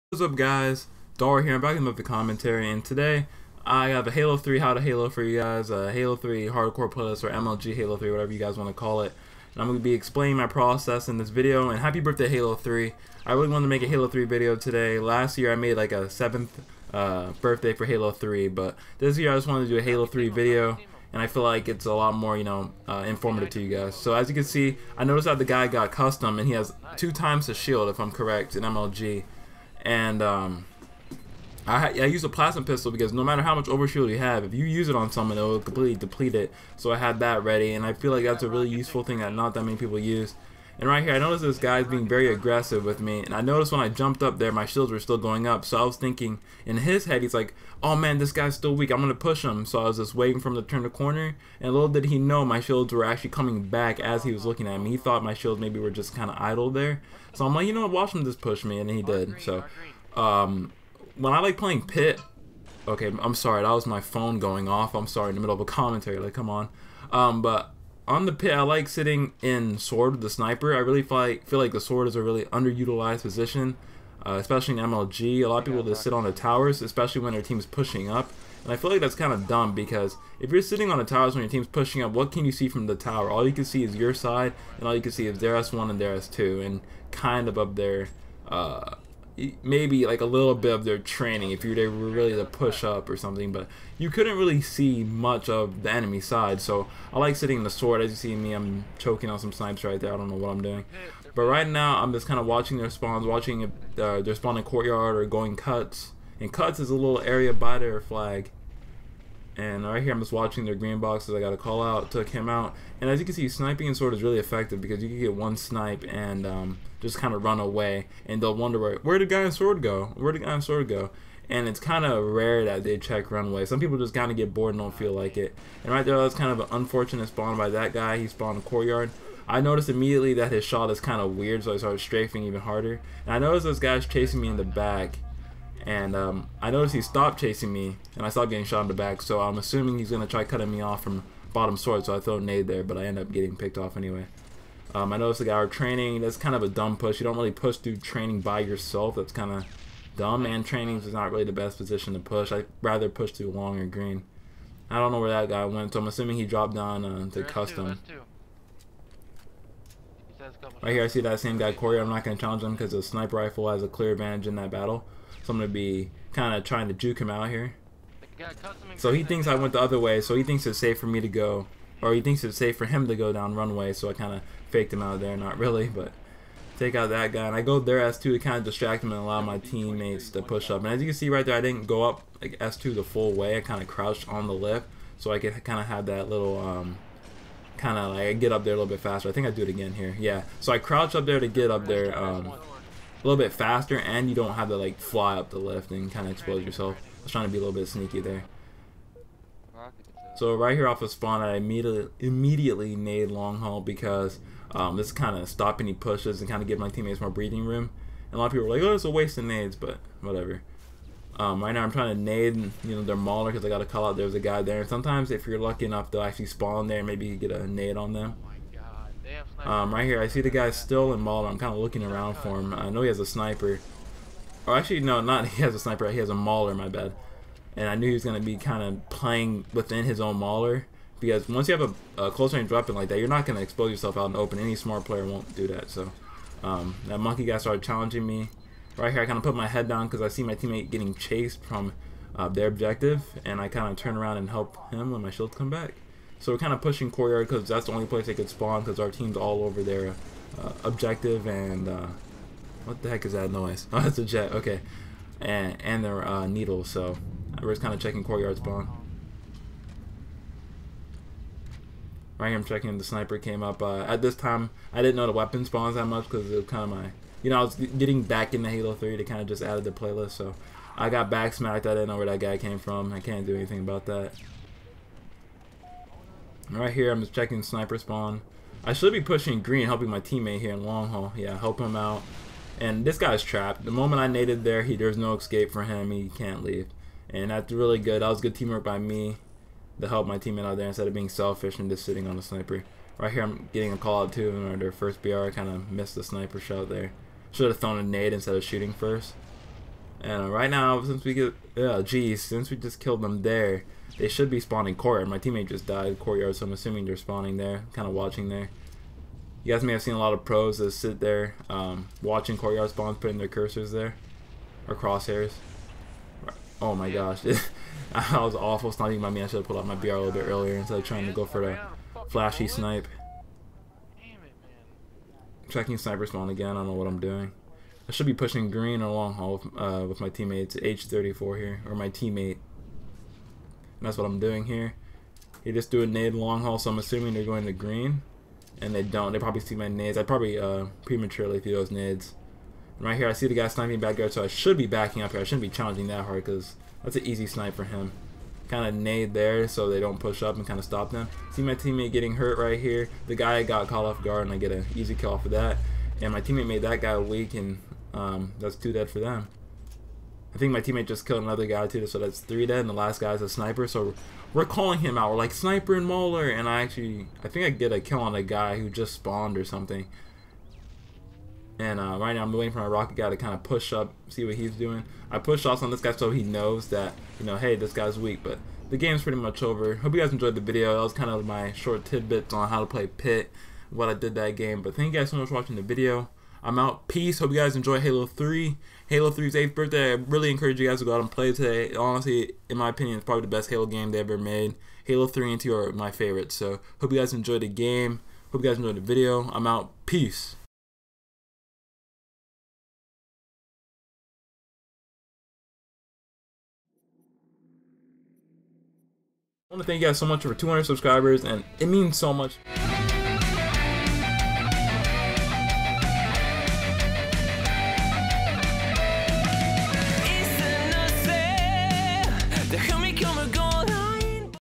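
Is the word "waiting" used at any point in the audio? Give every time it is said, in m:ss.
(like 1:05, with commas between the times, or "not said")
0:50, 6:12.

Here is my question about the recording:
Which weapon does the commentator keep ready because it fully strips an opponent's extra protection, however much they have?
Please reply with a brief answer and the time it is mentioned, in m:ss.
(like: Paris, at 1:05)
Plasma pistol, at 0:32.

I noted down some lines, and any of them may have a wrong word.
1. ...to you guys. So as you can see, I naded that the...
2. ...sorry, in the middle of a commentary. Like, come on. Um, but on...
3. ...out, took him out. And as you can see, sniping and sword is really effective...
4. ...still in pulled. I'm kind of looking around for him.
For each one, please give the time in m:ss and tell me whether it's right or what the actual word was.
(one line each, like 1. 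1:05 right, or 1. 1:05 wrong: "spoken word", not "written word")
1. 0:23 wrong: "noticed", not "naded"
2. 1:05 right
3. 1:51 right
4. 3:40 wrong: "involved", not "pulled".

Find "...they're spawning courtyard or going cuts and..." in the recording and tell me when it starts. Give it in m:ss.
1:44.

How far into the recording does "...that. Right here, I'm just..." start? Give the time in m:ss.
4:34.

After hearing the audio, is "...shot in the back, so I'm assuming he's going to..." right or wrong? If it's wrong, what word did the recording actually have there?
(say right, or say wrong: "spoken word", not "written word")
right.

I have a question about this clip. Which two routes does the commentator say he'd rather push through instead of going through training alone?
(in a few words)
Long or green.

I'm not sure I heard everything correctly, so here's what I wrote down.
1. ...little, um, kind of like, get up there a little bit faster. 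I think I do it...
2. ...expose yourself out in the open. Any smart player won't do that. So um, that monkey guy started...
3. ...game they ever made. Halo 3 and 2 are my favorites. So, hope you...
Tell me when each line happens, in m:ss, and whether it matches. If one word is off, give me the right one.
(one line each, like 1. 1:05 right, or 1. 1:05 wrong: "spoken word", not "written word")
1. 3:06 right
2. 3:53 right
3. 6:33 right.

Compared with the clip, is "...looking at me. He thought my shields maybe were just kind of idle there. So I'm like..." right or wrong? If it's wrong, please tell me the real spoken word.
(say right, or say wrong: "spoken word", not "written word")
right.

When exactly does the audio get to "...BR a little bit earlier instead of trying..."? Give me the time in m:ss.
5:19.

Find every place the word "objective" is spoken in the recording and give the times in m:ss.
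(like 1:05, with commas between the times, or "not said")
4:02, 4:10.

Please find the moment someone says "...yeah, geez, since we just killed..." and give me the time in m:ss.
5:01.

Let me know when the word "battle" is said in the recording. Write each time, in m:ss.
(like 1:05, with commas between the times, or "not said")
2:44.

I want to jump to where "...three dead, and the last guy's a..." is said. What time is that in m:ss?
6:02.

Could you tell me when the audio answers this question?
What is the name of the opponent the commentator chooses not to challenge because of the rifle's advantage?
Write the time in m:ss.
2:41.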